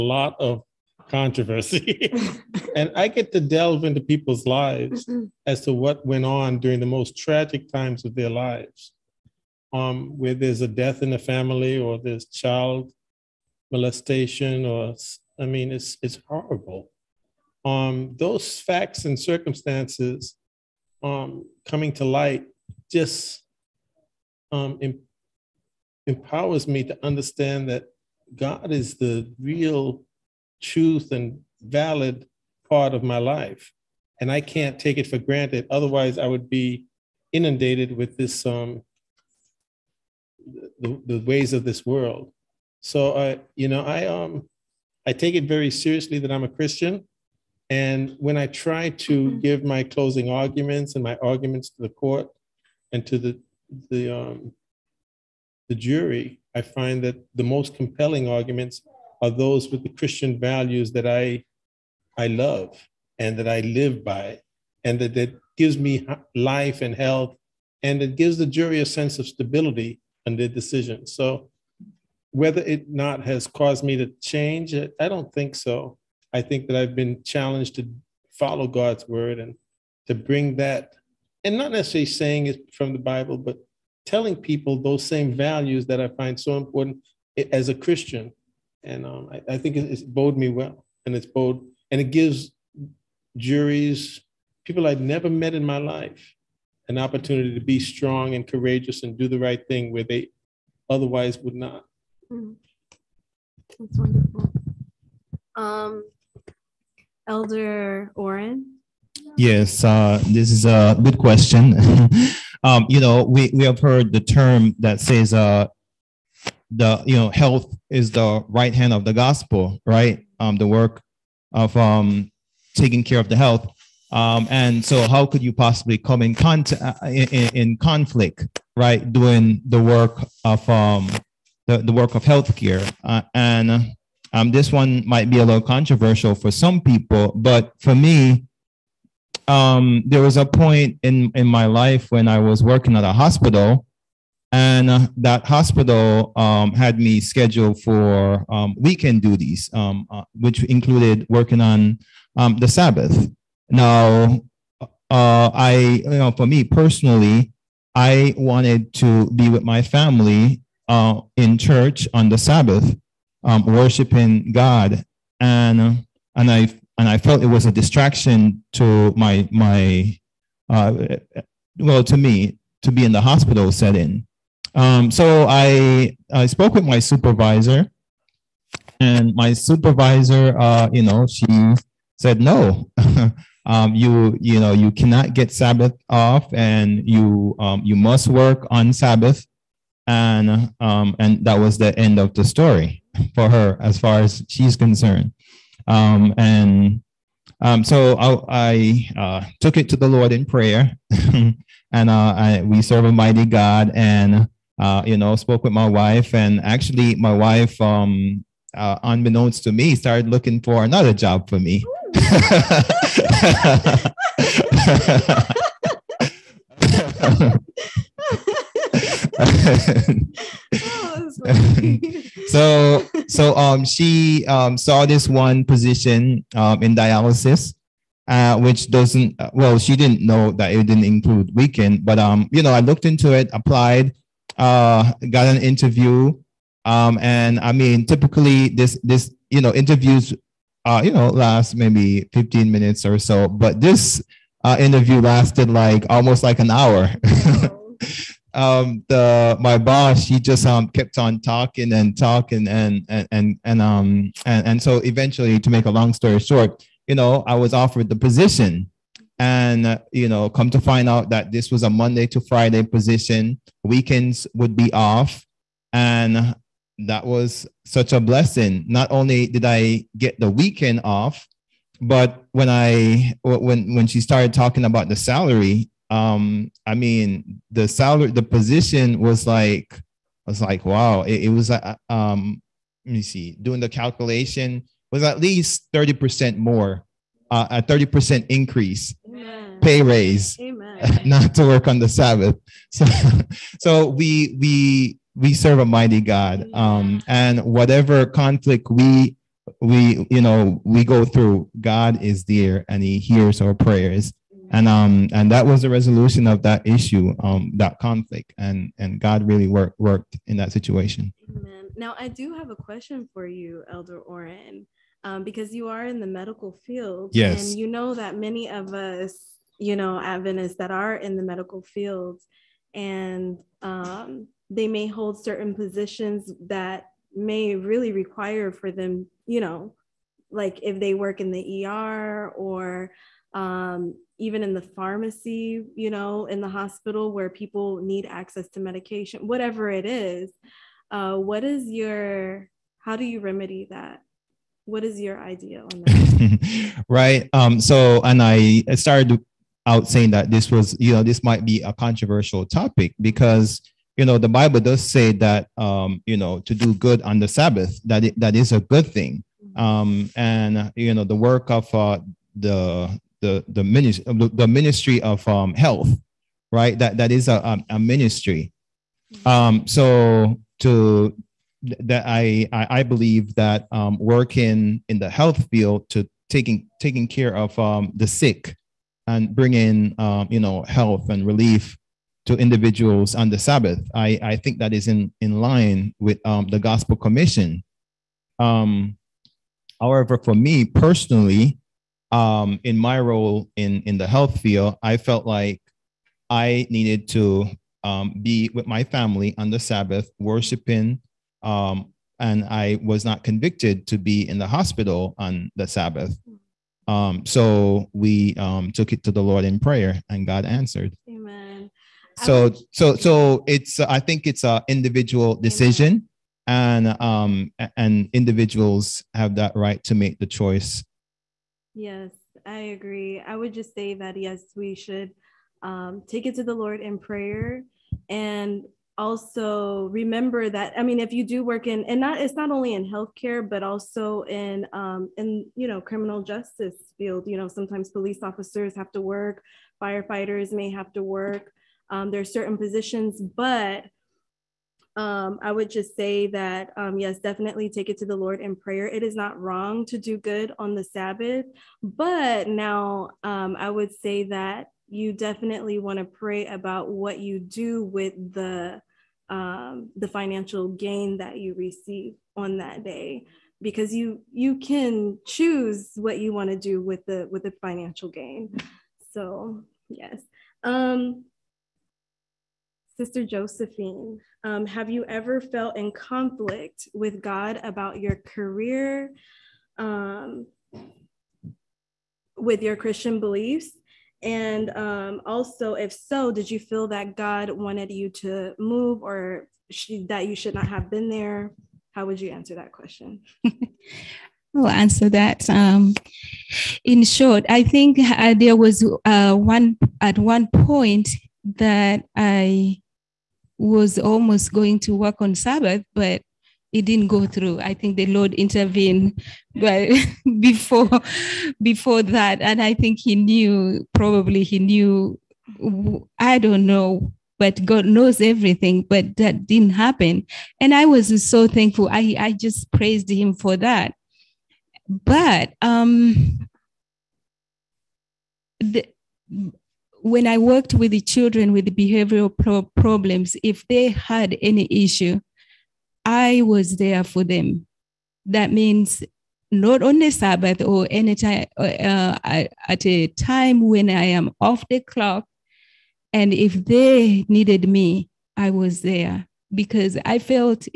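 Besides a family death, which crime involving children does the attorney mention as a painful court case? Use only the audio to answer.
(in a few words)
child molestation.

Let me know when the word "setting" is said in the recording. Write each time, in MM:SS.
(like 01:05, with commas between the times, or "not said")
02:53.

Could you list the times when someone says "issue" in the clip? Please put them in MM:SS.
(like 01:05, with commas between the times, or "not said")
05:06, 08:54.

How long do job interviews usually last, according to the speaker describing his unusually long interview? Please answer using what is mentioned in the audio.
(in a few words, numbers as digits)
15 minutes.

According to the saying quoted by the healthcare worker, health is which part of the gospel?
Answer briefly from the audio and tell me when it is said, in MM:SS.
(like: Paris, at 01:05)
the right hand, at 01:58.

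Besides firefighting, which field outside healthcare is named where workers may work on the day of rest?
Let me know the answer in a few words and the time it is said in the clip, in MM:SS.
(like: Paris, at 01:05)
criminal justice, at 07:15.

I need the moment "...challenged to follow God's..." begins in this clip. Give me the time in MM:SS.
01:17.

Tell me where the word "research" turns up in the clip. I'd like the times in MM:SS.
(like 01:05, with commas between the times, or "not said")
not said.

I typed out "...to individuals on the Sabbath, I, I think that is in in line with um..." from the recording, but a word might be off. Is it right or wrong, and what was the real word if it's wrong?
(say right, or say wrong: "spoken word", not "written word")
right.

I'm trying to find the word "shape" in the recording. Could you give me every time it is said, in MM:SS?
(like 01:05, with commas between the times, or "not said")
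not said.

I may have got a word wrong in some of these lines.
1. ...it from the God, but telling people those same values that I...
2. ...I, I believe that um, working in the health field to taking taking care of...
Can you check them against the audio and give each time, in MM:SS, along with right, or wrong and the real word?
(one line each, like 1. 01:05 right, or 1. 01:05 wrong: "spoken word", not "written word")
1. 01:22 wrong: "Bible", not "God"
2. 06:12 right.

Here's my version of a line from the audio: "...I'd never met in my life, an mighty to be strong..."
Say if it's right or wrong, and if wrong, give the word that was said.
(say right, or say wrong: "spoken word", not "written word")
wrong: "opportunity", not "mighty".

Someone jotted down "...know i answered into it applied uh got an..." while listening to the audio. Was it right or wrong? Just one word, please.
wrong.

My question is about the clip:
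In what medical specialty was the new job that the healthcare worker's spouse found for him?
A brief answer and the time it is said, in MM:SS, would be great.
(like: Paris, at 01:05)
dialysis, at 03:46.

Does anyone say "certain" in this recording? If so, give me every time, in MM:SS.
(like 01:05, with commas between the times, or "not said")
05:25, 07:22.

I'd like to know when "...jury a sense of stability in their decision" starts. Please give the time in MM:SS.
01:08.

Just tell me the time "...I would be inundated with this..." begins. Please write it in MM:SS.
00:36.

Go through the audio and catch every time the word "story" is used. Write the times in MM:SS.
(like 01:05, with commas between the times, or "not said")
03:12, 04:16.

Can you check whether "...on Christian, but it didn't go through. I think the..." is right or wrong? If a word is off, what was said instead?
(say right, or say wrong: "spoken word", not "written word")
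wrong: "Sabbath", not "Christian".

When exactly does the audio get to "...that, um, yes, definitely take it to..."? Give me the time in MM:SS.
07:26.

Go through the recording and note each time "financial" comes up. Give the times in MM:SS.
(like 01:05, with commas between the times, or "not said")
07:40, 07:47.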